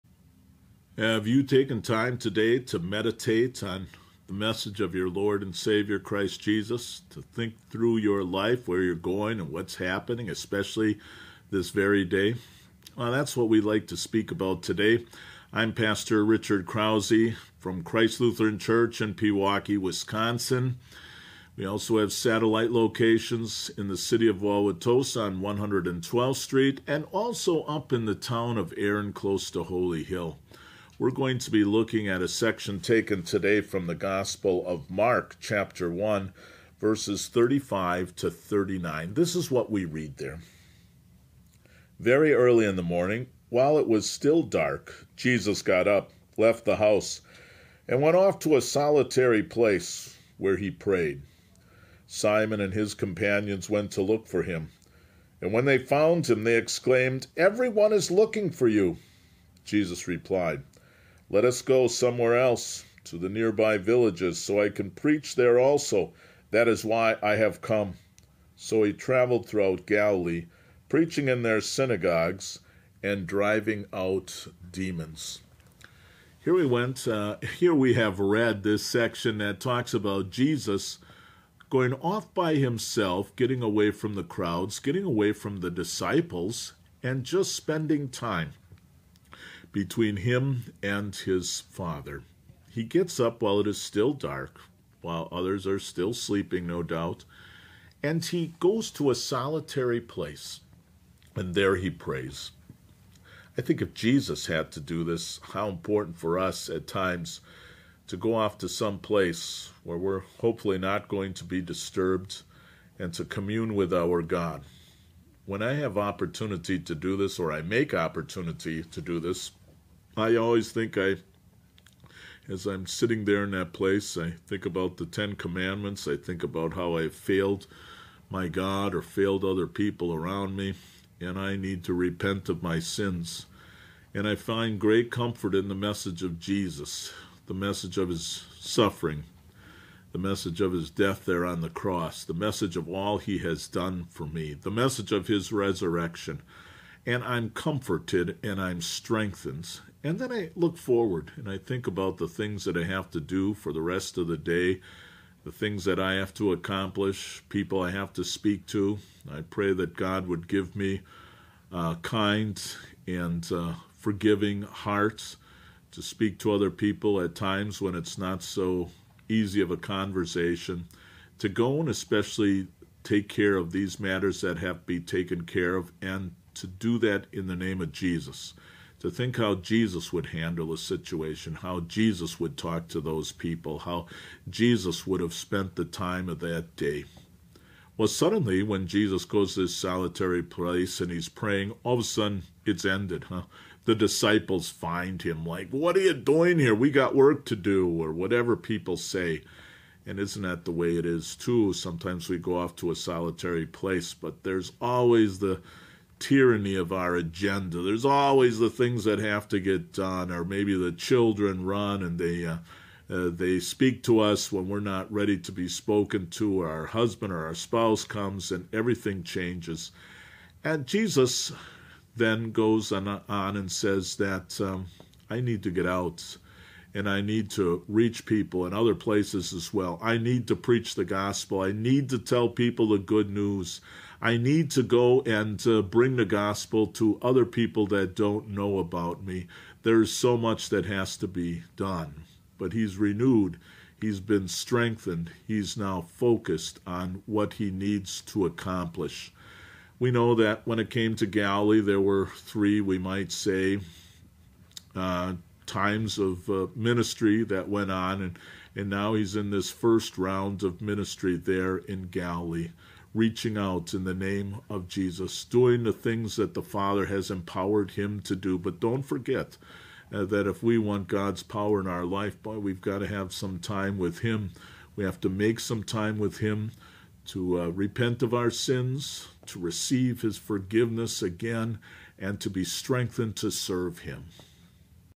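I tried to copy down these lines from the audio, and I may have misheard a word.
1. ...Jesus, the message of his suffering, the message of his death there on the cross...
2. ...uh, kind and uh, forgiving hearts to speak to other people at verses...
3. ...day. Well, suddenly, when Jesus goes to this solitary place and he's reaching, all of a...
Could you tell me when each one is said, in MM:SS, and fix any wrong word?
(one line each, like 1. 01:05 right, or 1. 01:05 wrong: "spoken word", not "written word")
1. 02:16 right
2. 02:41 wrong: "times", not "verses"
3. 03:06 wrong: "praying", not "reaching".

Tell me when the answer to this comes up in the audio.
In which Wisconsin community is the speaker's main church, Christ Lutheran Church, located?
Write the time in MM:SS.
00:19.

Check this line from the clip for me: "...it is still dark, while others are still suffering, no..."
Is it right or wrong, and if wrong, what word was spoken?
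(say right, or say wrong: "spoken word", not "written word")
wrong: "sleeping", not "suffering".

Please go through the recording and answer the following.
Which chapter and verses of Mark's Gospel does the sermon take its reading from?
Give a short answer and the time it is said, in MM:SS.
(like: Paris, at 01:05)
Chapter 1, verses 35 to 39, at 00:35.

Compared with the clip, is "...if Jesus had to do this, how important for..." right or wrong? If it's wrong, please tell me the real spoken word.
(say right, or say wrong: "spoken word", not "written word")
right.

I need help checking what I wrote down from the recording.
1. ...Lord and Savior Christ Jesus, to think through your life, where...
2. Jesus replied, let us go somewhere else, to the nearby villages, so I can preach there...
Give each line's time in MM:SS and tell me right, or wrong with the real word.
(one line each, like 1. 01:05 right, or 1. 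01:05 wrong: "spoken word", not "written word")
1. 00:05 right
2. 00:59 right.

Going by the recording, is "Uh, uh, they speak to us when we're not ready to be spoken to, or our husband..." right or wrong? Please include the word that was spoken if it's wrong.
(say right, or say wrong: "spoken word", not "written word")
right.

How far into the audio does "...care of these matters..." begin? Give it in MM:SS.
02:53.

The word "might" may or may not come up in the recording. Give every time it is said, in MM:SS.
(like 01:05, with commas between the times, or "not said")
04:12.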